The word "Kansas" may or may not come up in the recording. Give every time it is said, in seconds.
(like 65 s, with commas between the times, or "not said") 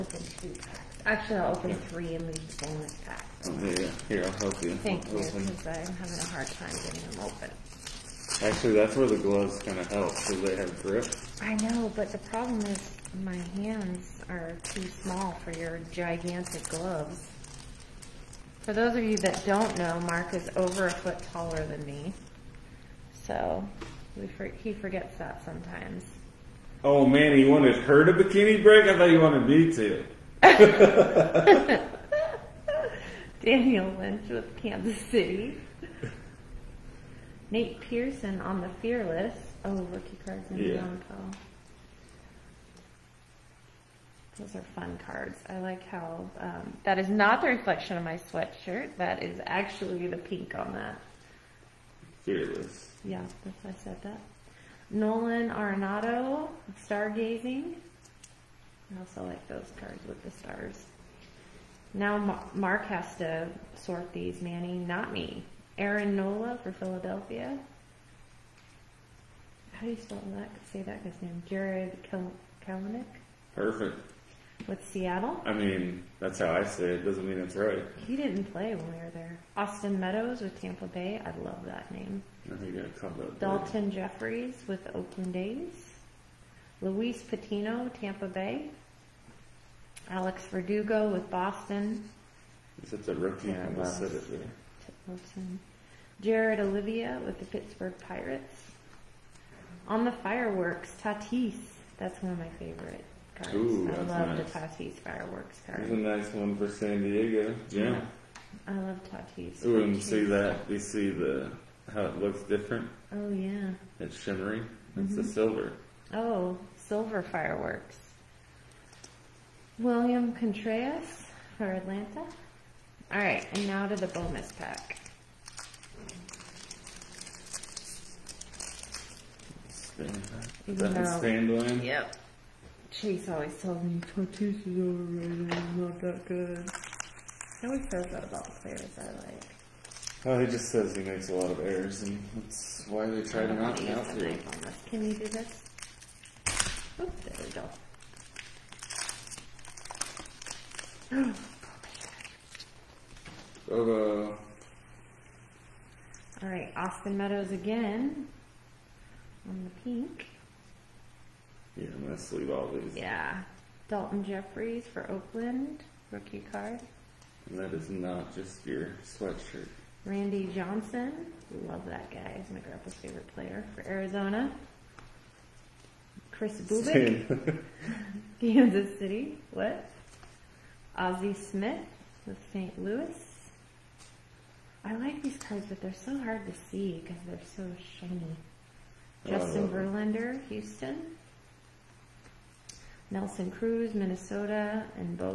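34 s, 178 s.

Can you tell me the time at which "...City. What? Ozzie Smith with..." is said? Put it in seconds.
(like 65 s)
178 s.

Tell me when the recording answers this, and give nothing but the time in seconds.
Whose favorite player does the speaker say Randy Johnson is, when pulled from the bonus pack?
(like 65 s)
172 s.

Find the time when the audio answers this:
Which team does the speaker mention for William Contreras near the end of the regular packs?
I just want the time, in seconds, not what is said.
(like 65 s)
121 s.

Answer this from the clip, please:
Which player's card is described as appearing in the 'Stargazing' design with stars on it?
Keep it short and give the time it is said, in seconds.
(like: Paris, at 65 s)
Nolan Arenado, at 54 s.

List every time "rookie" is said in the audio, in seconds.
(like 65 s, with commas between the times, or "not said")
39 s, 93 s, 166 s.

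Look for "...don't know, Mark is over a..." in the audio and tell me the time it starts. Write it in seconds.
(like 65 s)
19 s.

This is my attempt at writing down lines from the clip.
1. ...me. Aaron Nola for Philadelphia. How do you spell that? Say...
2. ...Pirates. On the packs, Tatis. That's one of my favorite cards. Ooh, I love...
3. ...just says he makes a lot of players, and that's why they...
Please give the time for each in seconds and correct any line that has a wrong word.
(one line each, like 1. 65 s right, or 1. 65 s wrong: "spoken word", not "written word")
1. 65 s right
2. 98 s wrong: "fireworks", not "packs"
3. 140 s wrong: "errors", not "players".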